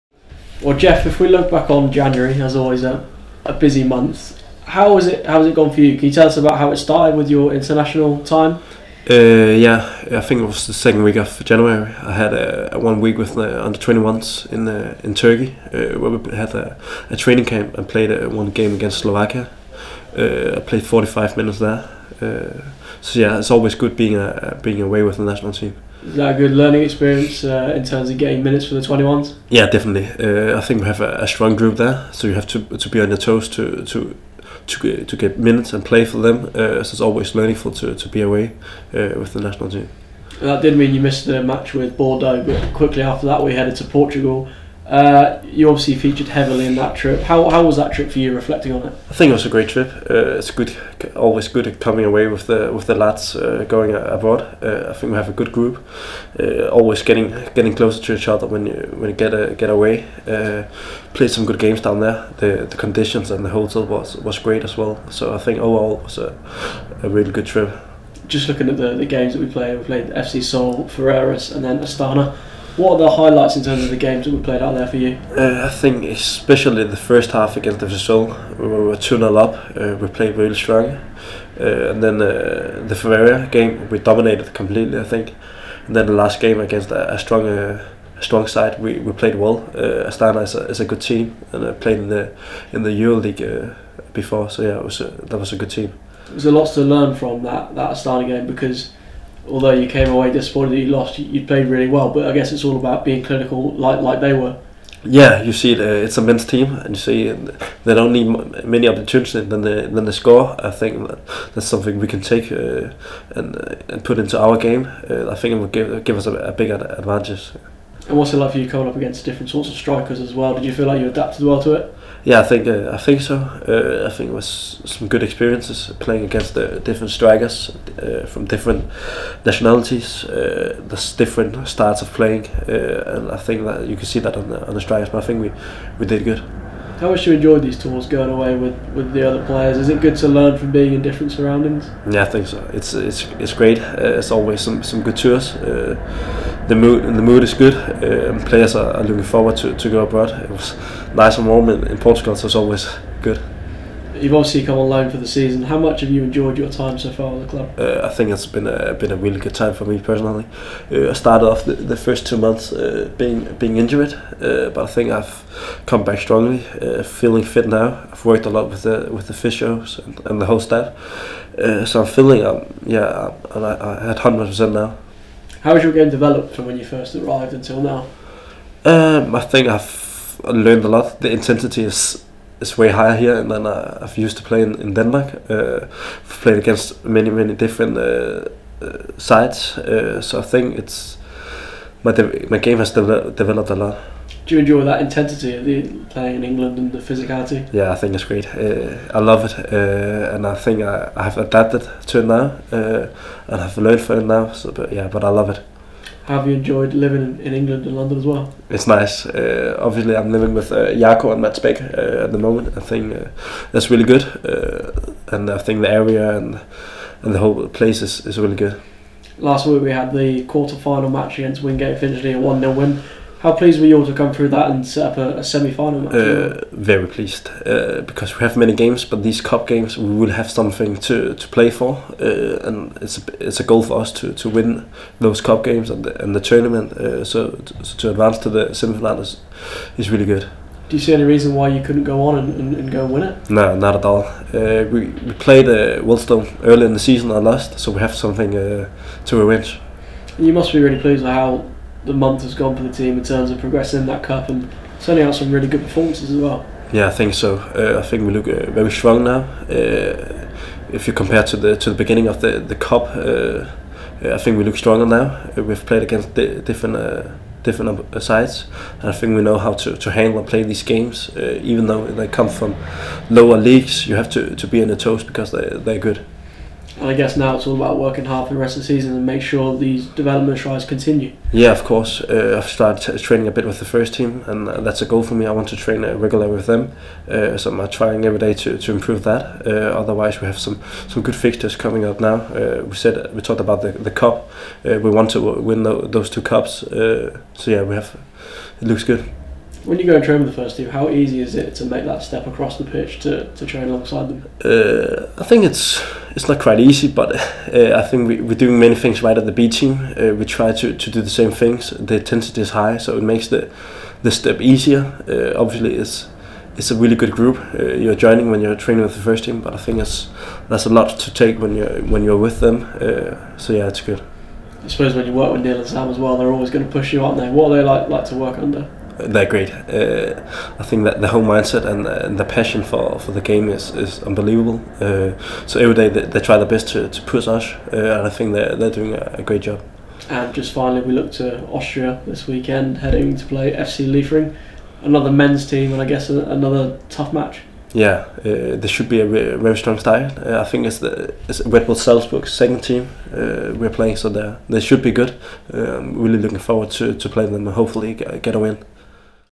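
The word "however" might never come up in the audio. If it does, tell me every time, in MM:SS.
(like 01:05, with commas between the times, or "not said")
not said.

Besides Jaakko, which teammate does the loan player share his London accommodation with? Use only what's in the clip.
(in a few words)
Mads Bech.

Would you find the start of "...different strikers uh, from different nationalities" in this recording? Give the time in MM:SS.
02:06.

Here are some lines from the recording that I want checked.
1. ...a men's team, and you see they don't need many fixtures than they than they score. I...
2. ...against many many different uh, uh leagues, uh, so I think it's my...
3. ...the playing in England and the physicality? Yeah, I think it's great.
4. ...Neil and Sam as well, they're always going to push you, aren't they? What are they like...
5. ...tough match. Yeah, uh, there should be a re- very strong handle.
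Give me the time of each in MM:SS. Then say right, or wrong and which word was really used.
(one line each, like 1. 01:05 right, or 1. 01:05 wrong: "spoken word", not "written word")
1. 01:46 wrong: "opportunities", not "fixtures"
2. 03:06 wrong: "sides", not "leagues"
3. 03:15 right
4. 05:25 right
5. 05:47 wrong: "style", not "handle".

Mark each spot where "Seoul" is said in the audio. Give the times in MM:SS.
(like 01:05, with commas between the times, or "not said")
01:10.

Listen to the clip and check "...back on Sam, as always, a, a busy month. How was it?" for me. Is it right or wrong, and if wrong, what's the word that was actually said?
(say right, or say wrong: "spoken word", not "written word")
wrong: "January", not "Sam".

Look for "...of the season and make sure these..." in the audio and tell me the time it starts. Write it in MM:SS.
04:38.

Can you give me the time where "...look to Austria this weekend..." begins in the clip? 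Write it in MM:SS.
05:41.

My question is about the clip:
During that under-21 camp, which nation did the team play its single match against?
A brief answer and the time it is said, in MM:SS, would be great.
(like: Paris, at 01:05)
Slovakia, at 00:18.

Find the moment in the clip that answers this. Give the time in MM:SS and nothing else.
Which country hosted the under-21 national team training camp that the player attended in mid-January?
00:15.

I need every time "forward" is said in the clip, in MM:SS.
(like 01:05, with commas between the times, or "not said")
02:29, 05:56.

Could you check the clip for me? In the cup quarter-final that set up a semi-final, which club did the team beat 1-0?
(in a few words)
Wingate.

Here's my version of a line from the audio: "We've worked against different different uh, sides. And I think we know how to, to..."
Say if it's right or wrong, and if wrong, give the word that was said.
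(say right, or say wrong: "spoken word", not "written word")
wrong: "played", not "worked".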